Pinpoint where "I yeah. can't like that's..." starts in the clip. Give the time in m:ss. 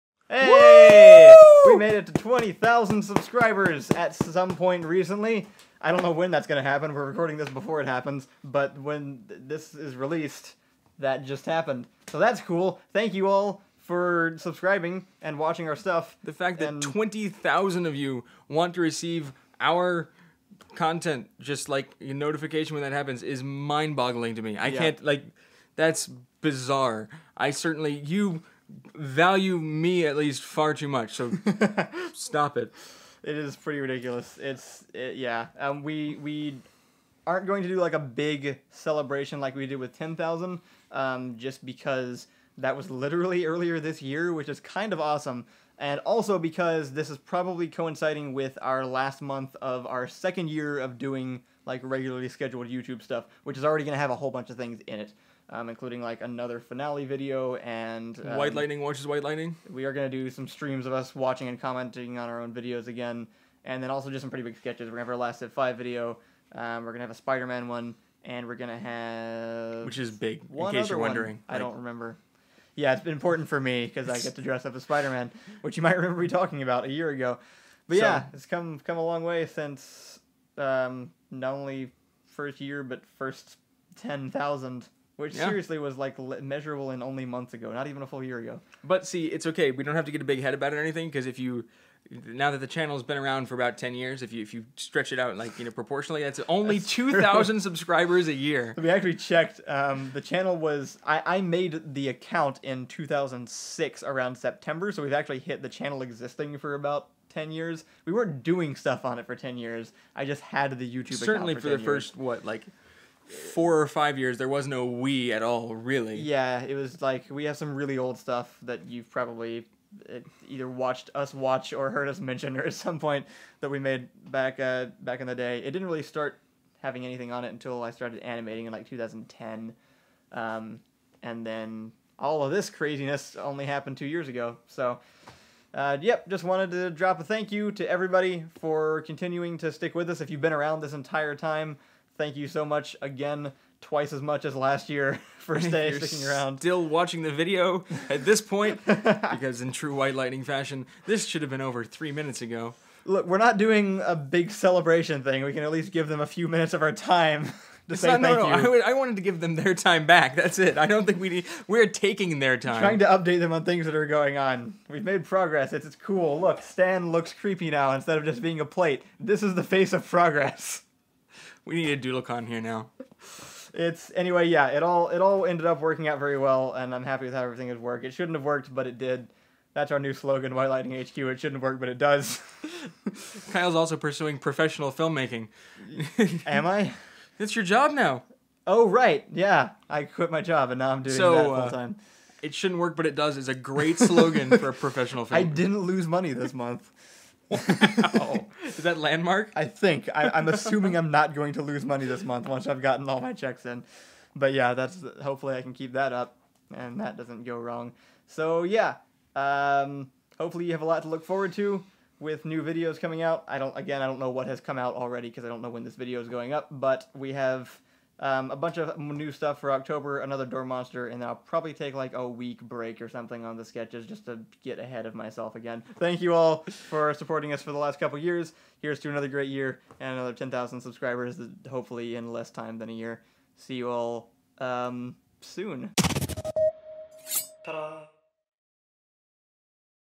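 0:24.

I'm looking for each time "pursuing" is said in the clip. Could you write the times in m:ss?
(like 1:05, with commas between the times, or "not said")
3:03.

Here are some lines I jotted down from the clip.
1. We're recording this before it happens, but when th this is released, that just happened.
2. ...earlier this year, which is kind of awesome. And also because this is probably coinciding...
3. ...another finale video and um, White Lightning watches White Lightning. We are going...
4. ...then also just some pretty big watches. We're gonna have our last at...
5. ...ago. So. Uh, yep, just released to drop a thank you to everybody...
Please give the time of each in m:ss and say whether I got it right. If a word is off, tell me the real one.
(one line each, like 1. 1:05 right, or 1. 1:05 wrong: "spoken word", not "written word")
1. 0:06 right
2. 0:43 right
3. 0:56 right
4. 1:03 wrong: "sketches", not "watches"
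5. 2:14 wrong: "wanted", not "released".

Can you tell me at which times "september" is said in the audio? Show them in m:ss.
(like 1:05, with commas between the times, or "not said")
1:44.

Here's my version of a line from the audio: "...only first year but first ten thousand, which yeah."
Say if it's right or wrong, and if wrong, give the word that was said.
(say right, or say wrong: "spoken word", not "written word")
right.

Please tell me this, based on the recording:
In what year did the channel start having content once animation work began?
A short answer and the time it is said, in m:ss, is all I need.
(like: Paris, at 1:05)
2010, at 2:08.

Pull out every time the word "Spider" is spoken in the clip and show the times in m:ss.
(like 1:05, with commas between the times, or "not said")
1:07, 1:14.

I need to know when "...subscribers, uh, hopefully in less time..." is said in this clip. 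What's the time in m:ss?
3:50.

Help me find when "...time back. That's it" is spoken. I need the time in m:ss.
2:39.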